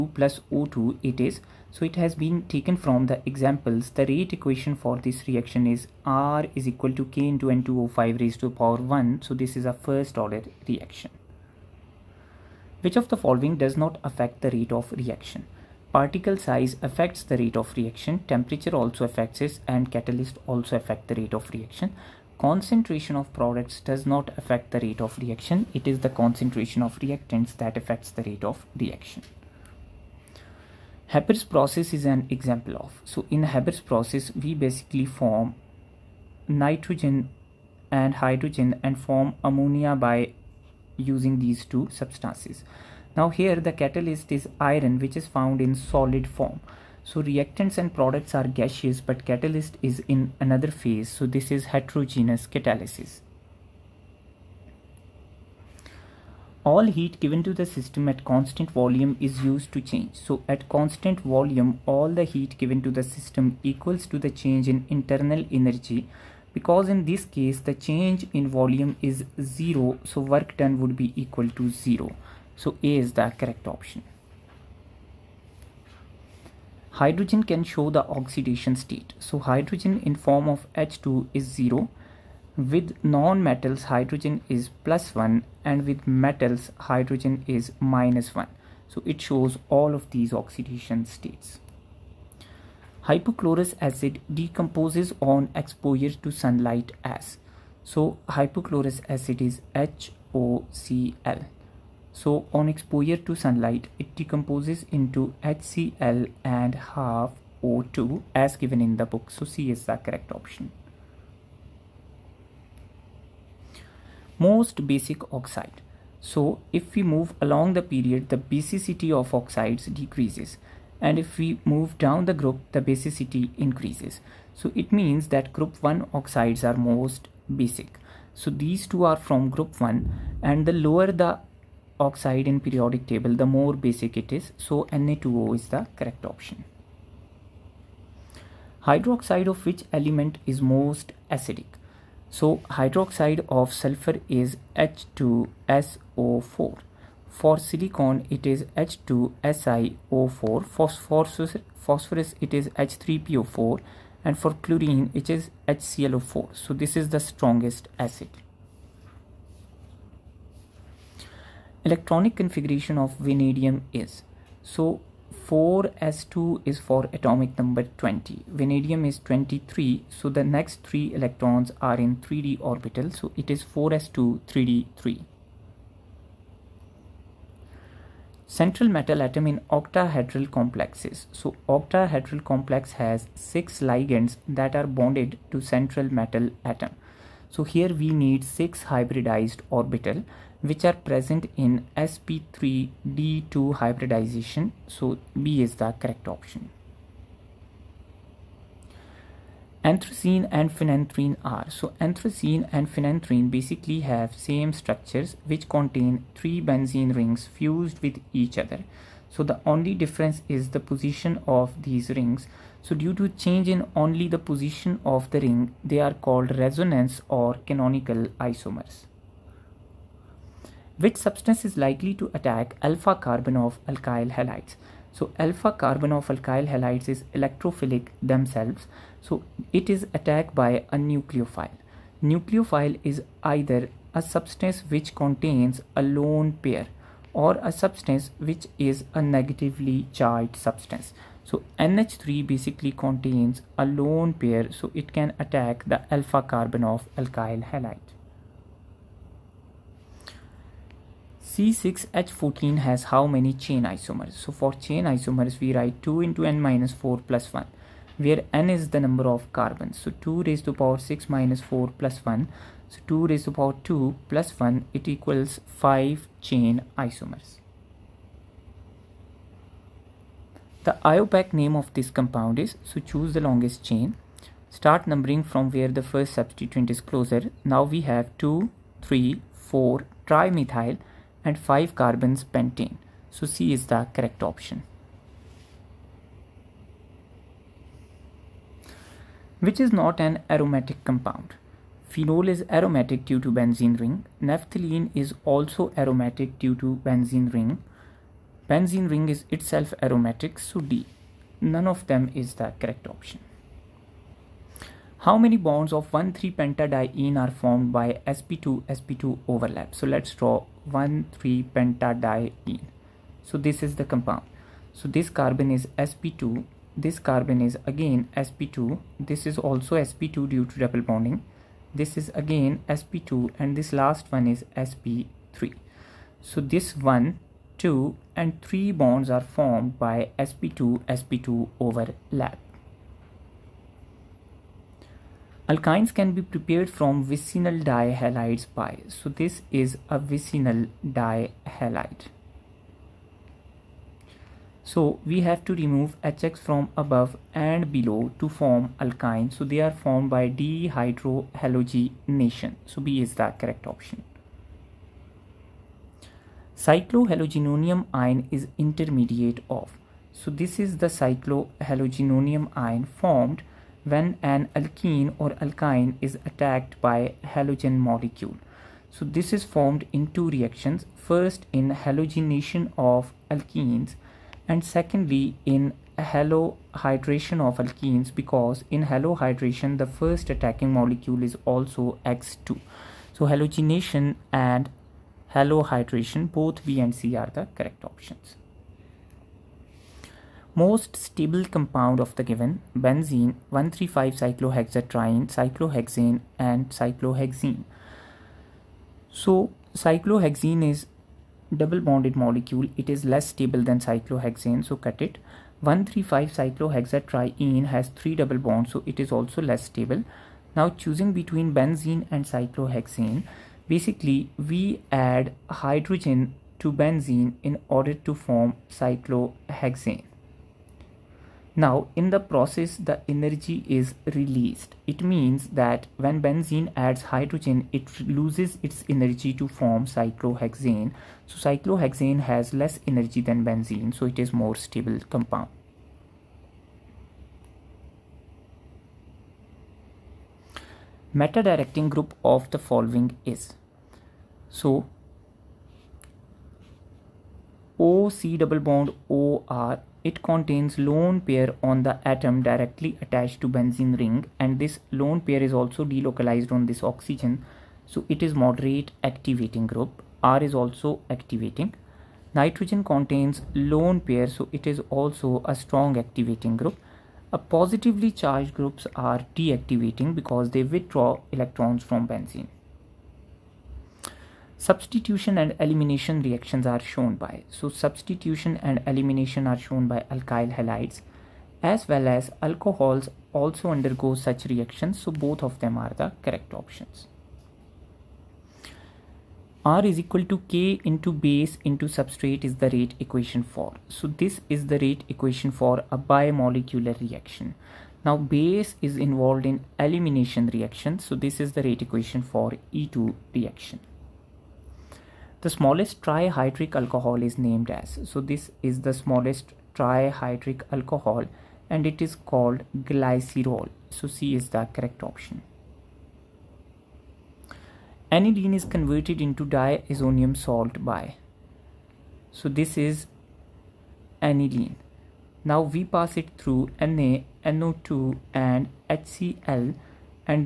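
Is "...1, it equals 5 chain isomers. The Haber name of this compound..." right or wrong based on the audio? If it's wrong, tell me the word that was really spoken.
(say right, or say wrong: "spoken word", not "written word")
wrong: "IUPAC", not "Haber".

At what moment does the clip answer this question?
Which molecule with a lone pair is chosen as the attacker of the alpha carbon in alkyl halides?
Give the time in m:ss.
4:01.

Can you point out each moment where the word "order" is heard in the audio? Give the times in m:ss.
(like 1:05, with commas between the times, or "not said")
0:10, 6:57.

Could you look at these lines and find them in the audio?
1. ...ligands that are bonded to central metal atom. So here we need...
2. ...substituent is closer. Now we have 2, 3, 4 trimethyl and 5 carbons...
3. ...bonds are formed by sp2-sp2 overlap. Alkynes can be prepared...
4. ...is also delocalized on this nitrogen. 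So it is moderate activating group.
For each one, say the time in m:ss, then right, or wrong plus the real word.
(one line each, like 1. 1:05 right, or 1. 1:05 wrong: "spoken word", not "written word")
1. 3:03 right
2. 4:36 right
3. 5:28 right
4. 7:35 wrong: "oxygen", not "nitrogen".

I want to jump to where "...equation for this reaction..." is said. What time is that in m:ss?
0:04.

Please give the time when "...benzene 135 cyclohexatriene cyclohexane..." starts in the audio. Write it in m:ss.
6:33.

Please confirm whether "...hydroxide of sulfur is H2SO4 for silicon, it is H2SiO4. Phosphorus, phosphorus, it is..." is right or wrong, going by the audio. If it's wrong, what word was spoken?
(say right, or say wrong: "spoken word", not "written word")
right.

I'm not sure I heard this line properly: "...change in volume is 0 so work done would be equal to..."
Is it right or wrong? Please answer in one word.
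right.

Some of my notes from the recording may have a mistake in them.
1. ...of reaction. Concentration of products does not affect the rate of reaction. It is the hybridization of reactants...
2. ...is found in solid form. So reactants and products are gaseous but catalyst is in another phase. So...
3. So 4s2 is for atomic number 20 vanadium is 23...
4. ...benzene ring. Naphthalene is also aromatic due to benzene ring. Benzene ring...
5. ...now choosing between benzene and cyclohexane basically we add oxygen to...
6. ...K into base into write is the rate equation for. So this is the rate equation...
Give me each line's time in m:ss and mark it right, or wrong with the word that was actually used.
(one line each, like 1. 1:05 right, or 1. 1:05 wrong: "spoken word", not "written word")
1. 0:21 wrong: "concentration", not "hybridization"
2. 0:45 right
3. 2:44 right
4. 4:53 right
5. 6:50 wrong: "hydrogen", not "oxygen"
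6. 8:10 wrong: "substrate", not "write".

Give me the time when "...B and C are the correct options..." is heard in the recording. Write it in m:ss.
6:26.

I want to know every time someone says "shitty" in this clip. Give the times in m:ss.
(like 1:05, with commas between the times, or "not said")
not said.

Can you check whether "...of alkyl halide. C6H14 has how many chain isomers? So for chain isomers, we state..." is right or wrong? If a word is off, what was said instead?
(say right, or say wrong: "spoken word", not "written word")
wrong: "write", not "state".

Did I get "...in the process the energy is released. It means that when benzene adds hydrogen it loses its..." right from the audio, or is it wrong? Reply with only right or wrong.
right.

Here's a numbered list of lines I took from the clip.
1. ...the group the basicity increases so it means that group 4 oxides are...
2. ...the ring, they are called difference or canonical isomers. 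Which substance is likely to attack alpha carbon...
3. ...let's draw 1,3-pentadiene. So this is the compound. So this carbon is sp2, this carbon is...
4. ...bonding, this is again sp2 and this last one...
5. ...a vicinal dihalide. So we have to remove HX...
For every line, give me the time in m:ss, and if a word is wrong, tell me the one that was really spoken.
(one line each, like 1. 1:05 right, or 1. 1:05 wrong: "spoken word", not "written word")
1. 2:02 wrong: "1", not "4"
2. 3:35 wrong: "resonance", not "difference"
3. 5:10 right
4. 5:21 right
5. 5:40 right.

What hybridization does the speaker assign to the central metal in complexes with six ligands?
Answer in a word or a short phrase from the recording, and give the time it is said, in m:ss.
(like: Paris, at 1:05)
sp3d2, at 3:11.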